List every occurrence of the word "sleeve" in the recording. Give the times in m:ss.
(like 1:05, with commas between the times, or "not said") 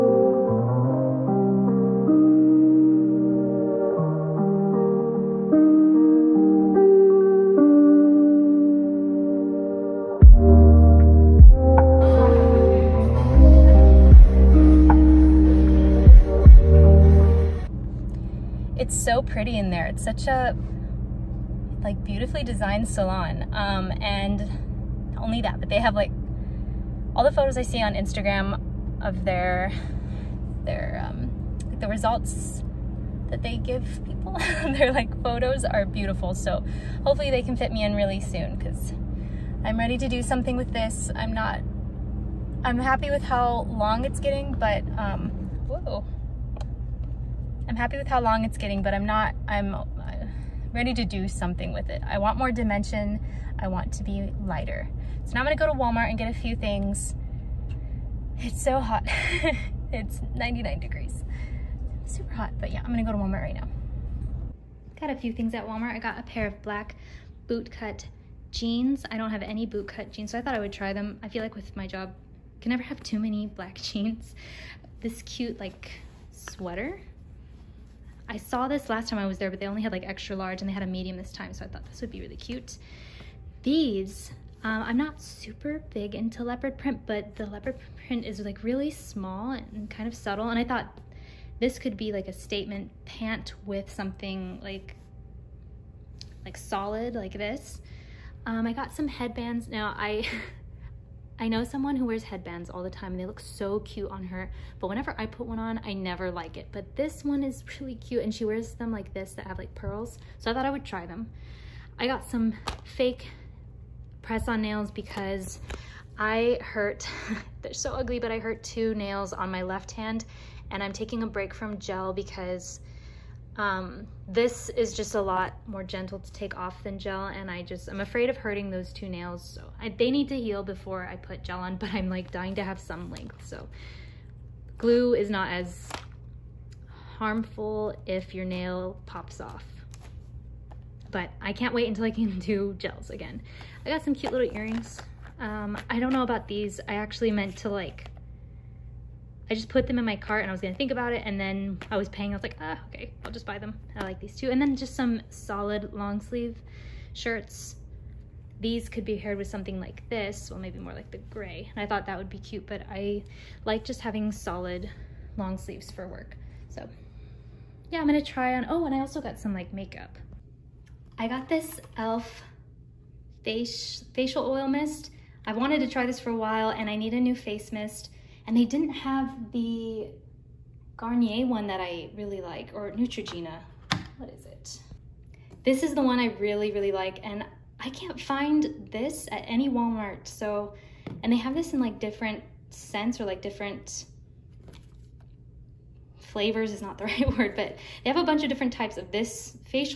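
2:36, 2:45.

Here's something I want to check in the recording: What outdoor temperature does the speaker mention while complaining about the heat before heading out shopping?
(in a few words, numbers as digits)
99 degrees.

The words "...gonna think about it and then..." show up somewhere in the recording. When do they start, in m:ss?
2:30.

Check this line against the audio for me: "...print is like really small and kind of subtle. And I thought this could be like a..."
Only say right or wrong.
right.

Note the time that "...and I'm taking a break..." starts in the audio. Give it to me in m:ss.
2:00.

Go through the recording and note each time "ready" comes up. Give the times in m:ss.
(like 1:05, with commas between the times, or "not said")
0:39, 0:50.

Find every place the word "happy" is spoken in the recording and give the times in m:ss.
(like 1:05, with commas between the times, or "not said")
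0:42, 0:47.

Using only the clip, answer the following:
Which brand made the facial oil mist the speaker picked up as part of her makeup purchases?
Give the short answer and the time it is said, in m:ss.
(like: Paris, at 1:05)
e.l.f., at 2:51.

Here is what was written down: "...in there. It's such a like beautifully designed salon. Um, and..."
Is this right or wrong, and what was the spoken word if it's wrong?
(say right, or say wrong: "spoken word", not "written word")
right.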